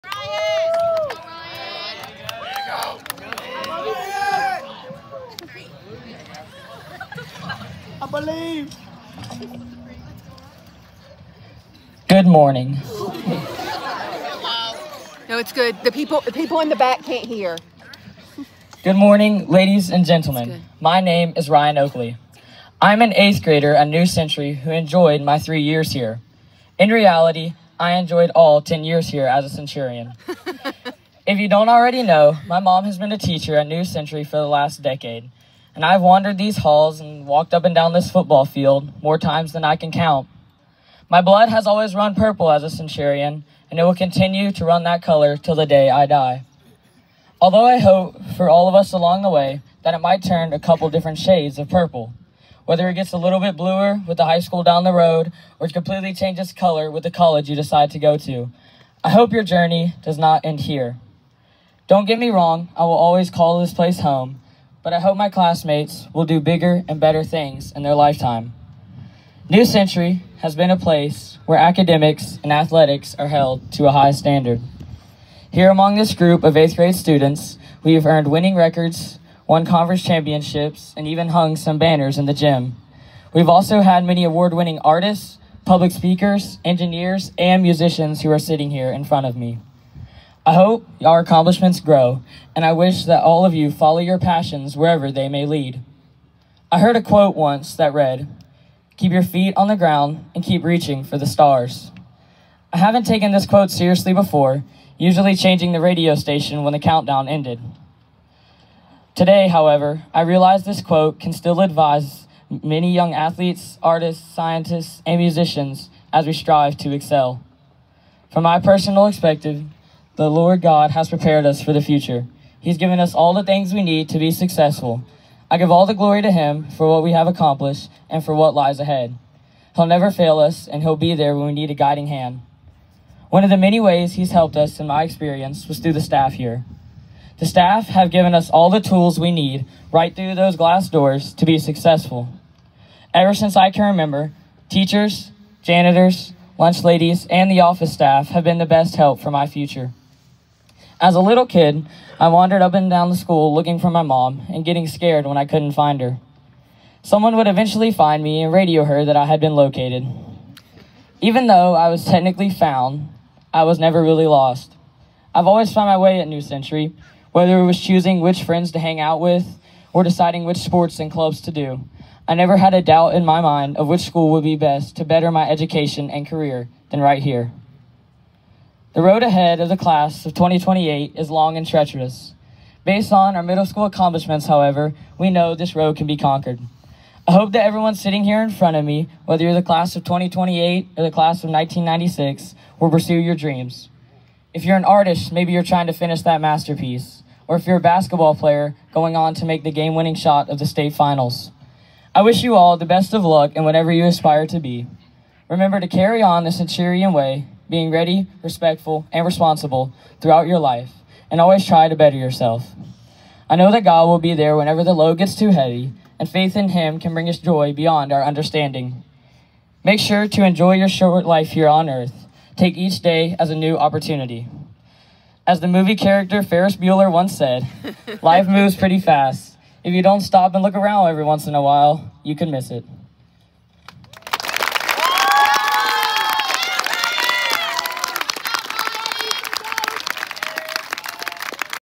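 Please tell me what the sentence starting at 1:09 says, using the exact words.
New Century has been a place where academics and athletics are held to a high standard.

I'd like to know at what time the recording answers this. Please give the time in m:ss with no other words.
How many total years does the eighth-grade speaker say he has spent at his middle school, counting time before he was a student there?
0:28.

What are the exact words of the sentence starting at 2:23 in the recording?
Ever since I can remember, teachers, janitors, lunch ladies, and the office staff have been the best help for my future.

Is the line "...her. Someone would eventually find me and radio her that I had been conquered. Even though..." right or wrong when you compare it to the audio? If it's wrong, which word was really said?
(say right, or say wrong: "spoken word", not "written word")
wrong: "located", not "conquered".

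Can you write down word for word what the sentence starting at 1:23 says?
We've also had many award-winning artists, public speakers, engineers, and musicians who are sitting here in front of me.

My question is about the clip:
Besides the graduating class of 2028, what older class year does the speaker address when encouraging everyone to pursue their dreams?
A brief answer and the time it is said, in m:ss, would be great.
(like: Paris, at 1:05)
1996, at 3:11.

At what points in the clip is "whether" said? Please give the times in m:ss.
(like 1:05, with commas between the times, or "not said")
0:52, 2:47, 3:09.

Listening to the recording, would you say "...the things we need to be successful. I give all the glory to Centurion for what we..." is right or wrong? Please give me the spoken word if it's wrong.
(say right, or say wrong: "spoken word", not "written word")
wrong: "Him", not "Centurion".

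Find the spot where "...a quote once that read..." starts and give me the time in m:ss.
1:36.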